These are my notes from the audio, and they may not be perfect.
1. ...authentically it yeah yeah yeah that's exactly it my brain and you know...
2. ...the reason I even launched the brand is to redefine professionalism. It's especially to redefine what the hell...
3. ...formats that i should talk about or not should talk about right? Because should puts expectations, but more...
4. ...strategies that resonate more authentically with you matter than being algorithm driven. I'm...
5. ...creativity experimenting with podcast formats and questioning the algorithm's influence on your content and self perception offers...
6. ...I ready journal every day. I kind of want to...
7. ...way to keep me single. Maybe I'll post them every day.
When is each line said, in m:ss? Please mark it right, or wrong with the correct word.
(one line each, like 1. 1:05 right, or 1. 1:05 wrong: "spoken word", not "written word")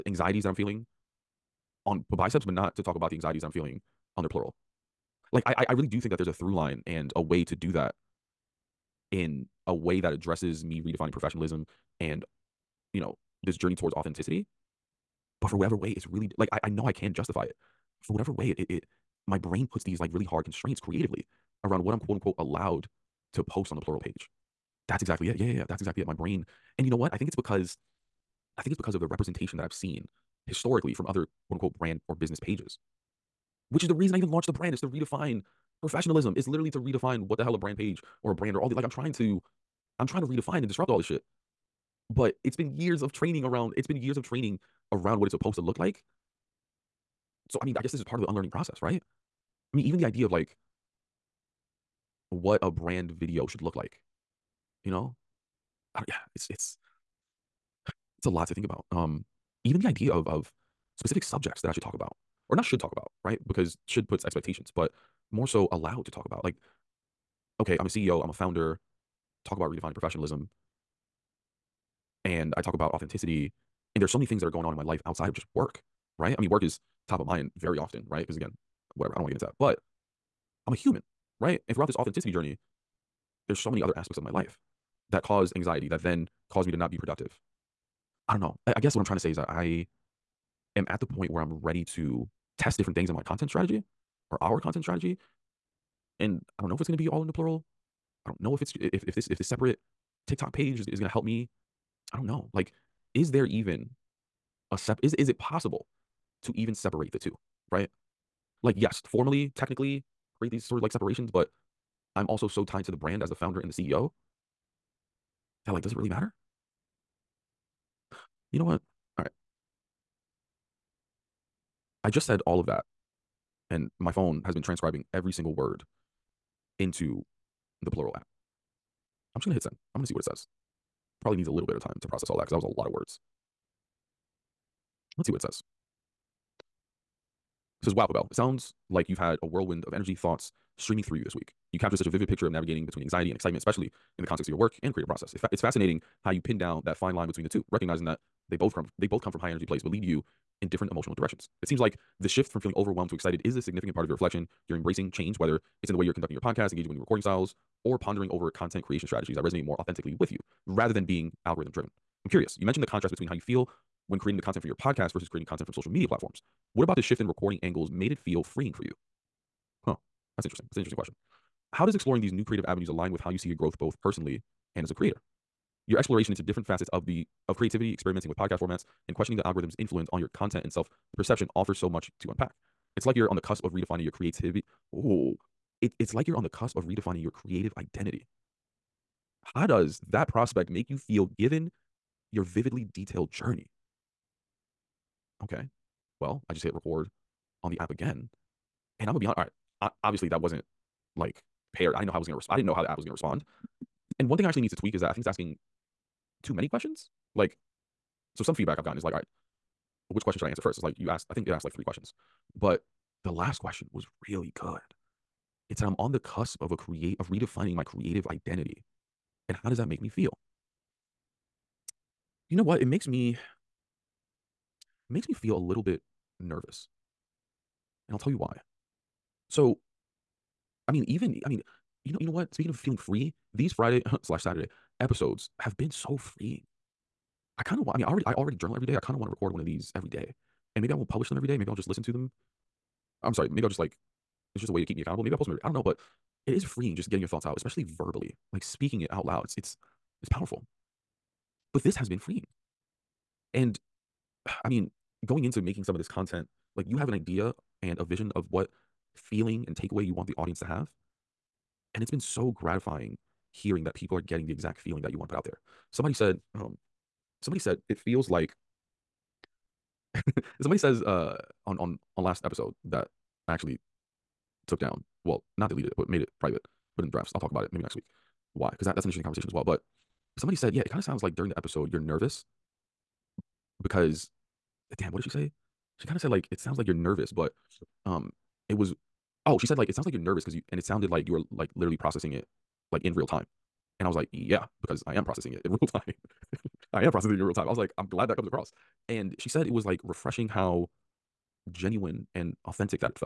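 1. 0:25 wrong: "exactly", not "authentically"
2. 0:33 wrong: "literally", not "especially"
3. 1:01 wrong: "subjects", not "formats"
4. 2:39 wrong: "rather", not "matter"
5. 2:57 right
6. 3:58 wrong: "already", not "ready"
7. 4:04 wrong: "accountable", not "single".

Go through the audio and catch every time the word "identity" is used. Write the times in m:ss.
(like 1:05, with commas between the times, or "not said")
3:07, 3:38.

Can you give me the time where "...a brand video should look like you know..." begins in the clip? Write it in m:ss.
0:52.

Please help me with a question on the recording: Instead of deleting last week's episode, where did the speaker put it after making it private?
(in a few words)
the drafts.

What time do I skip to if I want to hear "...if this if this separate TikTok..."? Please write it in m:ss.
1:39.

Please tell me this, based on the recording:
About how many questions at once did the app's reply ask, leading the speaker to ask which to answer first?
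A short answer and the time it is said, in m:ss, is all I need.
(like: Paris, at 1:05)
3, at 3:31.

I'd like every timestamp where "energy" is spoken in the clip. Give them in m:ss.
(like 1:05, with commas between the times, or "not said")
2:19, 2:29.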